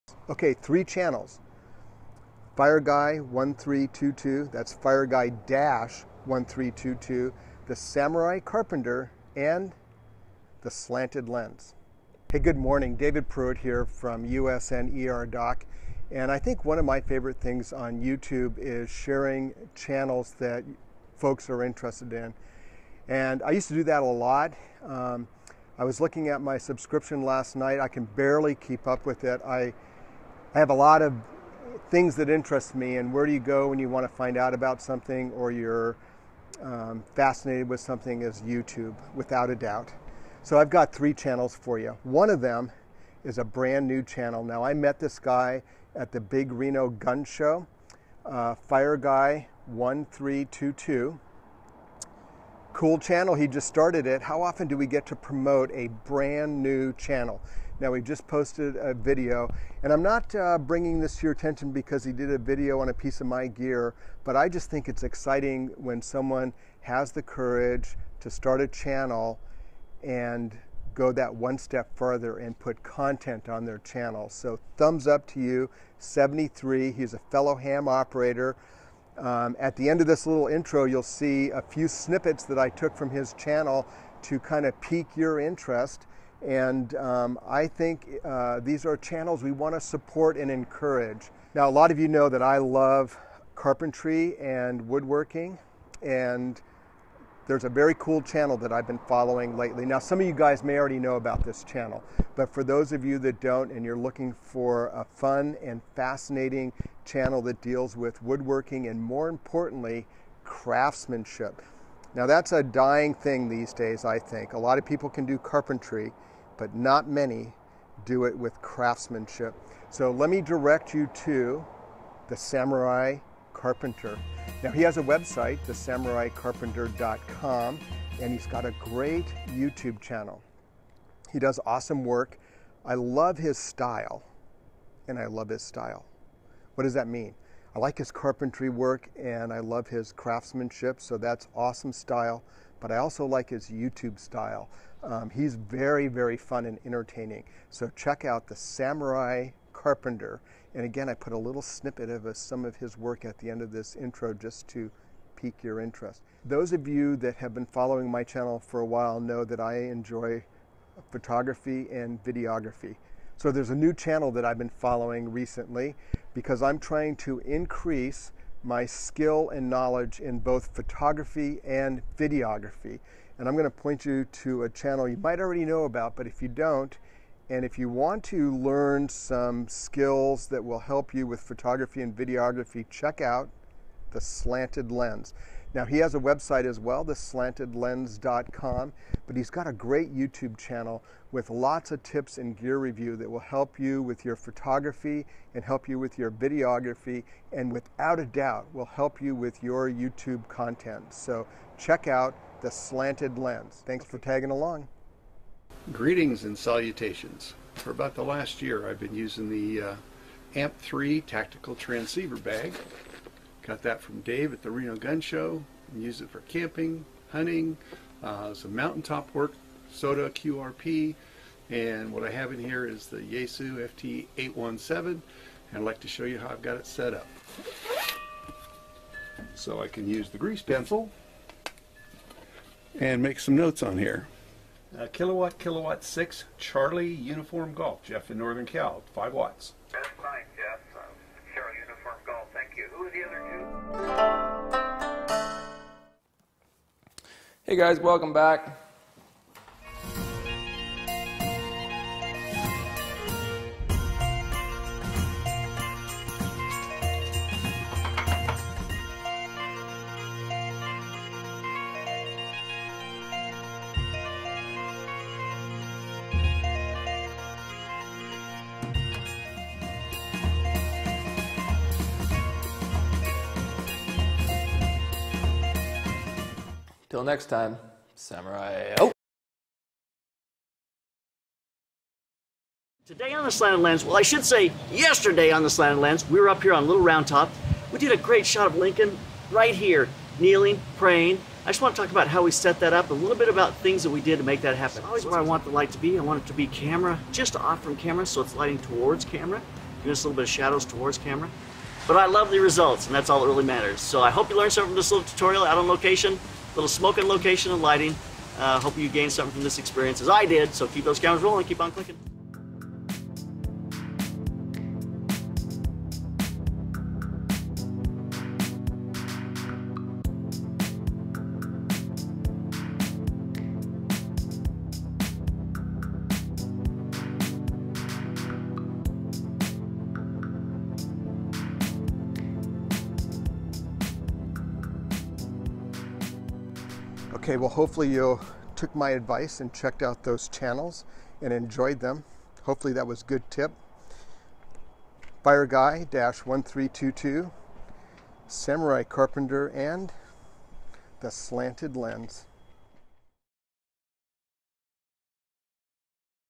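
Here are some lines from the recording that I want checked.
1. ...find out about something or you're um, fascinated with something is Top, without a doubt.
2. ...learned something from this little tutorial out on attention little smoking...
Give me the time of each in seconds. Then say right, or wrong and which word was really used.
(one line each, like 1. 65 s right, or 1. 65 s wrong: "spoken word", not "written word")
1. 34 s wrong: "YouTube", not "Top"
2. 304 s wrong: "location", not "attention".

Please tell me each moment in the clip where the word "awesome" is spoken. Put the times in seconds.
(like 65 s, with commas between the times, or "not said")
131 s, 141 s.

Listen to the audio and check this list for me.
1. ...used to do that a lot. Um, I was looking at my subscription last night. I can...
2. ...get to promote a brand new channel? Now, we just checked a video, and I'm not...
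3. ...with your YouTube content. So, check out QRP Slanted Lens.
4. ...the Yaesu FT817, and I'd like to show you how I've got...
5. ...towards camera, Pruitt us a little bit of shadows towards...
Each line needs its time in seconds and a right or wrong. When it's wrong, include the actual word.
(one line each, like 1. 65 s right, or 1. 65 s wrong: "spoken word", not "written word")
1. 23 s right
2. 54 s wrong: "posted", not "checked"
3. 199 s wrong: "The", not "QRP"
4. 223 s right
5. 298 s wrong: "Give", not "Pruitt".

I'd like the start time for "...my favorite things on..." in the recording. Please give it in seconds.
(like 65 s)
16 s.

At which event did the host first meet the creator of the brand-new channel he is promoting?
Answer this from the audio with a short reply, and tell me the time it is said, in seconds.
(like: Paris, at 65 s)
Big Reno Gun Show, at 46 s.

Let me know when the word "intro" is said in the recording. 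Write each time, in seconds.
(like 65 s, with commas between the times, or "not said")
80 s, 153 s.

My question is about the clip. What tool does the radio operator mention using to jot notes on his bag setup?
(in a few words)
grease pencil.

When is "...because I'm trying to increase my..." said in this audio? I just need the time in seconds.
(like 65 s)
166 s.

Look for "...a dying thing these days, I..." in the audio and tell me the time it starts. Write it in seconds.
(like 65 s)
112 s.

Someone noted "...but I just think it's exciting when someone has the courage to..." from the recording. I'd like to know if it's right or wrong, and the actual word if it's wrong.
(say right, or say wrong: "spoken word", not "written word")
right.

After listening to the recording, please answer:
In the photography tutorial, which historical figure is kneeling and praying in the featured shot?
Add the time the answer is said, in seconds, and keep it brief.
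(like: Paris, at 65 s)
Lincoln, at 288 s.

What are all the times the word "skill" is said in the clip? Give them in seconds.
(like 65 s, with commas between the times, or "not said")
168 s, 179 s.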